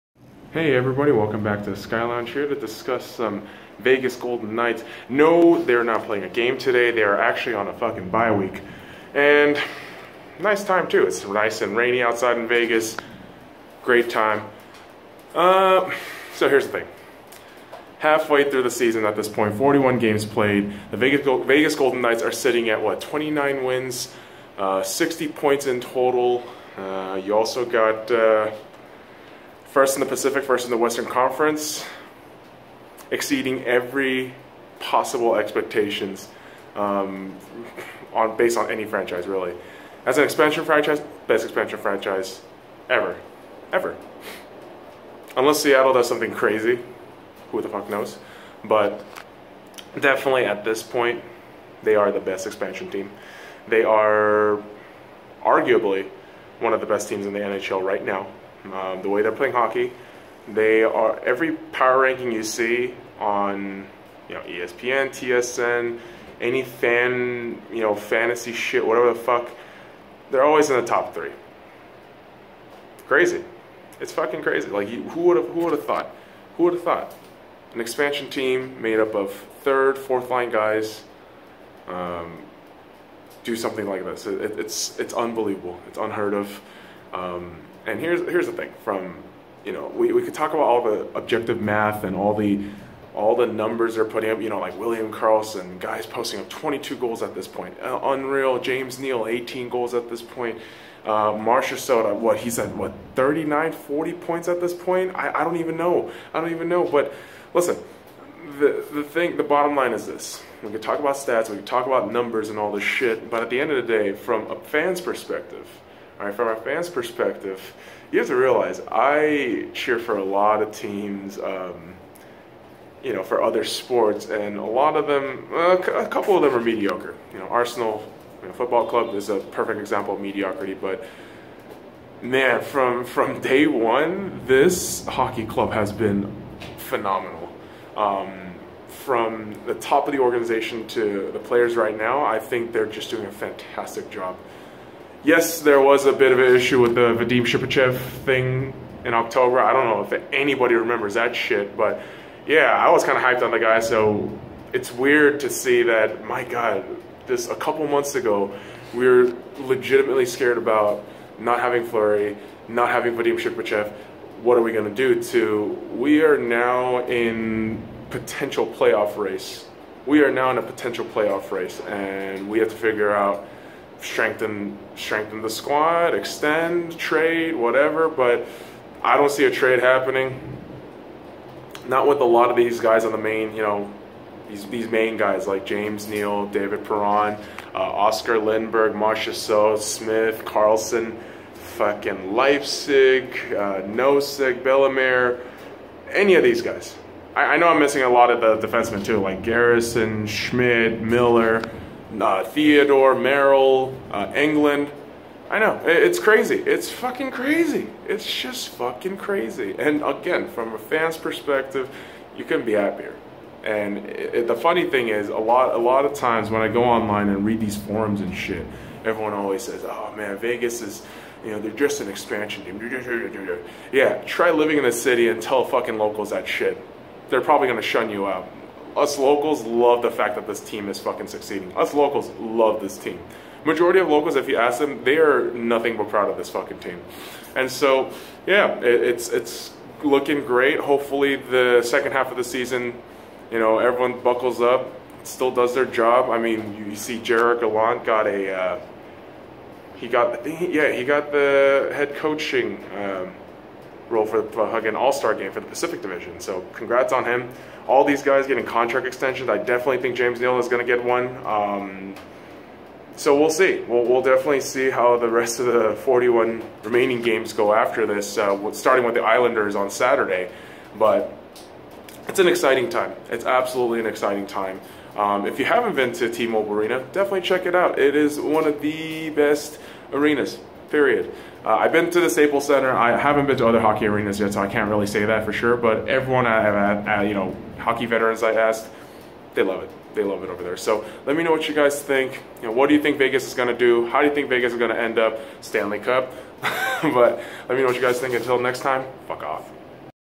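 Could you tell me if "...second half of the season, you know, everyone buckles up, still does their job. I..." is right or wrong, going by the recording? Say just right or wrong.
right.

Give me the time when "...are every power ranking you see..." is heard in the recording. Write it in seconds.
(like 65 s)
60 s.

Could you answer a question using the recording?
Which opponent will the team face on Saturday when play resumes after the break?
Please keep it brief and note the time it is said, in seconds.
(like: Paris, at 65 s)
the Islanders, at 269 s.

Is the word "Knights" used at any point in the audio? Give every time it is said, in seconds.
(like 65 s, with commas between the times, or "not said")
4 s, 22 s.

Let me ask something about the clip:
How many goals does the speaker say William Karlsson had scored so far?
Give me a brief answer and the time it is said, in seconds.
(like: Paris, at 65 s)
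22, at 96 s.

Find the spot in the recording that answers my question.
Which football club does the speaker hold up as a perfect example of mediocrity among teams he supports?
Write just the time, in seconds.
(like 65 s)
127 s.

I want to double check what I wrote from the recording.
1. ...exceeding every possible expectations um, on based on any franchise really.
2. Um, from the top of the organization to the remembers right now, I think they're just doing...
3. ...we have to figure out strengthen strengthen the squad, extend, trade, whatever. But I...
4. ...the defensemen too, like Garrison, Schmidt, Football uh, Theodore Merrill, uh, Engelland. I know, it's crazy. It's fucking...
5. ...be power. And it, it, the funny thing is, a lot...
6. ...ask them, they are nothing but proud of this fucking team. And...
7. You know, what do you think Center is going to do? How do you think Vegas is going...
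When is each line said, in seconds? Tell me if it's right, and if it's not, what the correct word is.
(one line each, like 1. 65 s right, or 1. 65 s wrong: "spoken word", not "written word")
1. 33 s right
2. 137 s wrong: "players", not "remembers"
3. 172 s right
4. 198 s wrong: "Miller", not "Football"
5. 212 s wrong: "happier", not "power"
6. 234 s right
7. 292 s wrong: "Vegas", not "Center".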